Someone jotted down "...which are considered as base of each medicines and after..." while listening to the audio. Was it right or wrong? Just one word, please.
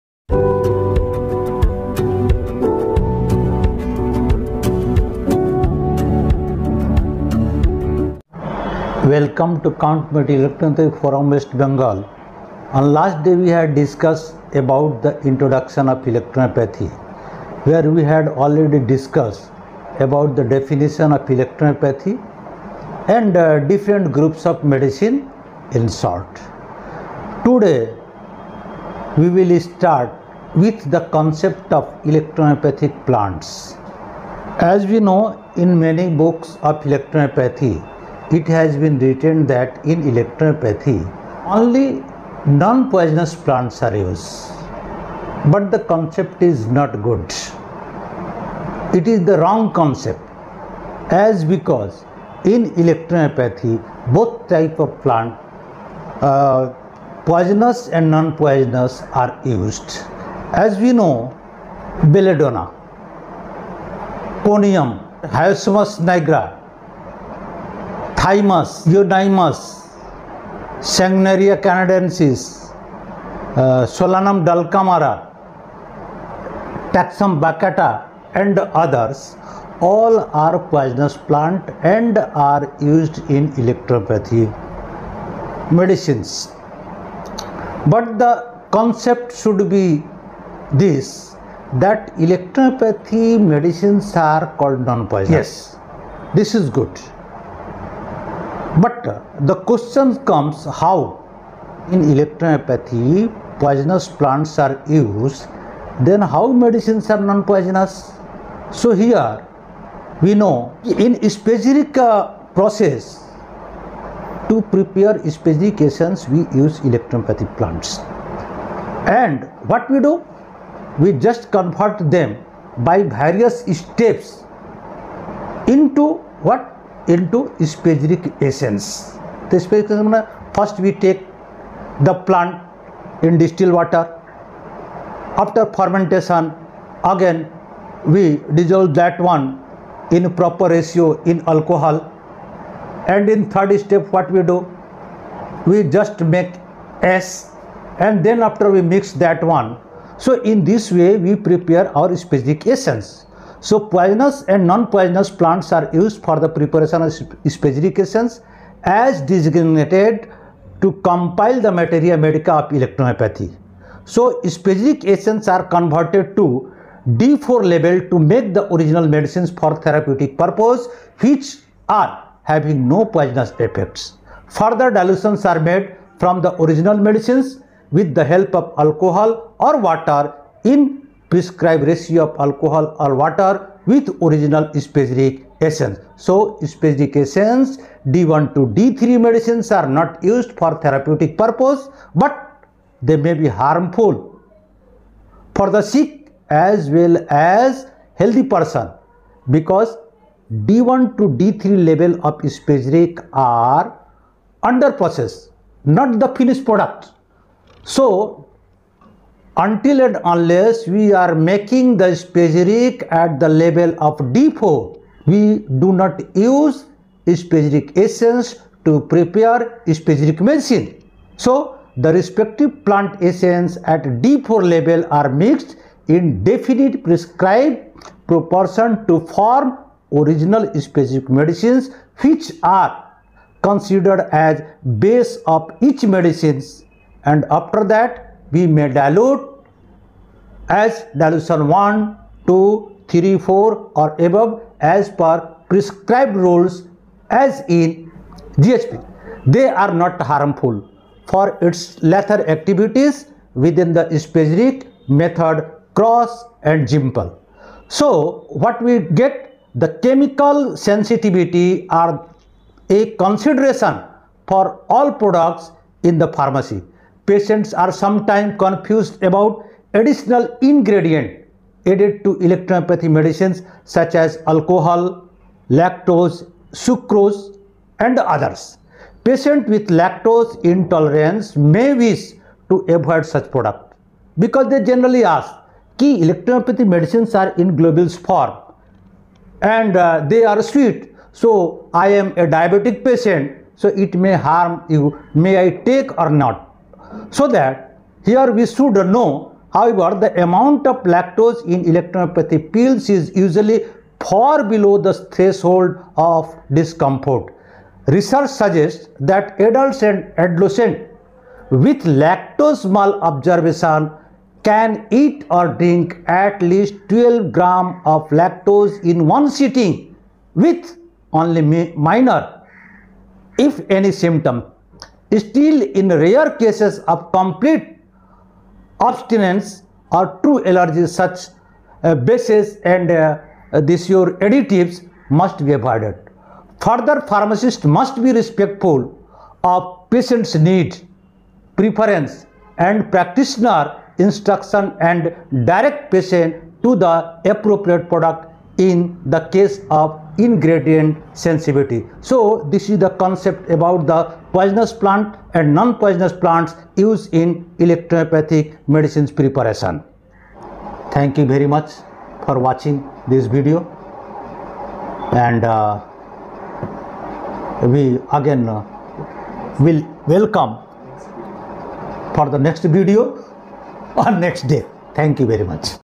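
right.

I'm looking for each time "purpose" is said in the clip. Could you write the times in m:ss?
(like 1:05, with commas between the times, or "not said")
2:50, 3:11.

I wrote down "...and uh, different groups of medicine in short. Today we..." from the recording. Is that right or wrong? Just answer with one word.
right.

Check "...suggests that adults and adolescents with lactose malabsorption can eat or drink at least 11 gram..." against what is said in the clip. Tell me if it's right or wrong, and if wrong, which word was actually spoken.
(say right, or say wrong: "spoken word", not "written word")
wrong: "12", not "11".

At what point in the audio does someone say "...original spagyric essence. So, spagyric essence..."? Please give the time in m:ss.
3:04.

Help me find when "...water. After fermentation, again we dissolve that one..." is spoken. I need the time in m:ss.
2:13.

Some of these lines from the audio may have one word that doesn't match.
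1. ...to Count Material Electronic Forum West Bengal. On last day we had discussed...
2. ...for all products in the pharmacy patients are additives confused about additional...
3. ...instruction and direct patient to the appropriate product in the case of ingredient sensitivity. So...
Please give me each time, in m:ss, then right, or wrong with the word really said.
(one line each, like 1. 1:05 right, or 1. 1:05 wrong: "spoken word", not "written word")
1. 0:09 right
2. 4:24 wrong: "sometimes", not "additives"
3. 5:44 right.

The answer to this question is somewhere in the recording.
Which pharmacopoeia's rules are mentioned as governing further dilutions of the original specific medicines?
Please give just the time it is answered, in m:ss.
4:08.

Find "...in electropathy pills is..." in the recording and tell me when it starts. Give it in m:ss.
5:01.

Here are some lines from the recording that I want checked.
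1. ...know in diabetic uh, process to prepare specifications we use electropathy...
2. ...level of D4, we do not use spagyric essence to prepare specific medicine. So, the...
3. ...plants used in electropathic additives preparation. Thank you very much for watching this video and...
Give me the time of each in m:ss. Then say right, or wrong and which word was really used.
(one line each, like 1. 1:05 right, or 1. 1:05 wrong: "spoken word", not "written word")
1. 1:50 wrong: "specific", not "diabetic"
2. 3:33 right
3. 5:56 wrong: "medicines", not "additives".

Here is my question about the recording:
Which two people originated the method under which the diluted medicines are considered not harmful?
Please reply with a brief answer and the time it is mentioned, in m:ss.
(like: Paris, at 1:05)
Krauss and Zimpel, at 4:15.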